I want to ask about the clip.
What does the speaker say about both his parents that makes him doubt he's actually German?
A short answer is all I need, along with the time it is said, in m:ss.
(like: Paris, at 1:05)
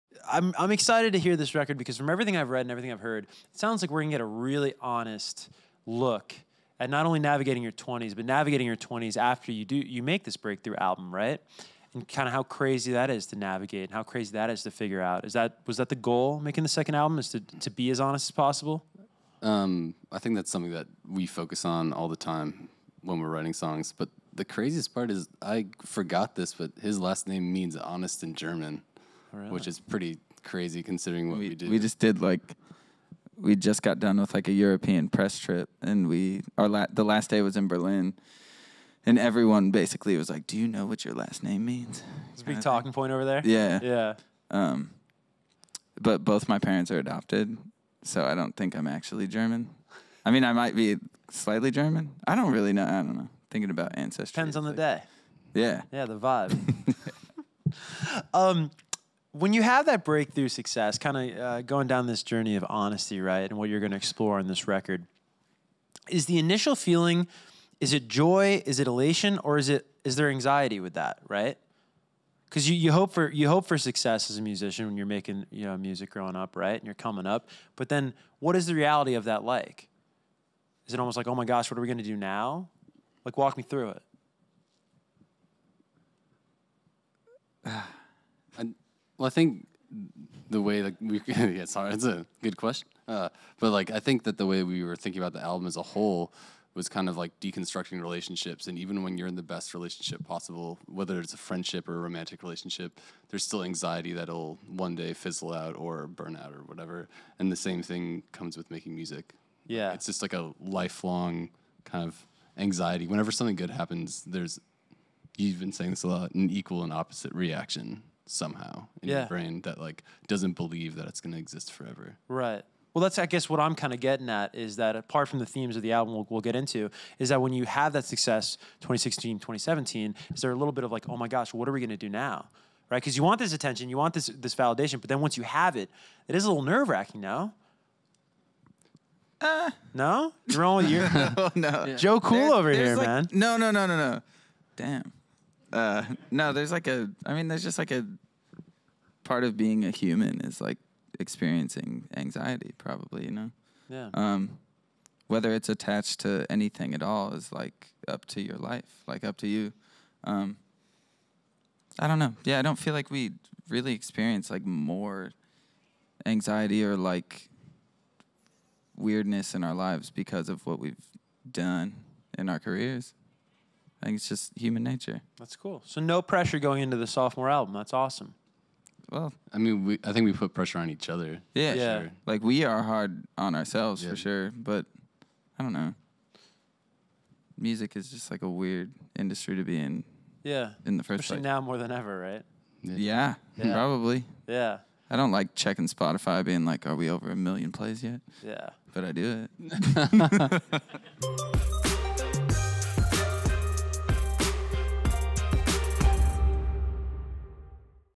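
Adopted, at 0:46.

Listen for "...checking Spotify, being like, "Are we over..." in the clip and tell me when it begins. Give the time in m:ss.
3:15.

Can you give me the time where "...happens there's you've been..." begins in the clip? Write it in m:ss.
1:53.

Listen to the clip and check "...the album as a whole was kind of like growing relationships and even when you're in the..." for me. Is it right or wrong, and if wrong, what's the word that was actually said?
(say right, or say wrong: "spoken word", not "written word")
wrong: "deconstructing", not "growing".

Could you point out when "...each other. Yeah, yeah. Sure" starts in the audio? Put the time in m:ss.
3:00.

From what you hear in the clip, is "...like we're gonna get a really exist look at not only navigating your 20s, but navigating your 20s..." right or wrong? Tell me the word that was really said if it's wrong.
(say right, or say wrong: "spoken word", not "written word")
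wrong: "honest", not "exist".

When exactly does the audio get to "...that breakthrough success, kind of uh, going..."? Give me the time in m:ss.
0:59.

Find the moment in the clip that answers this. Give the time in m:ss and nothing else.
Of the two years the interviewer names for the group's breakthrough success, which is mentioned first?
2:08.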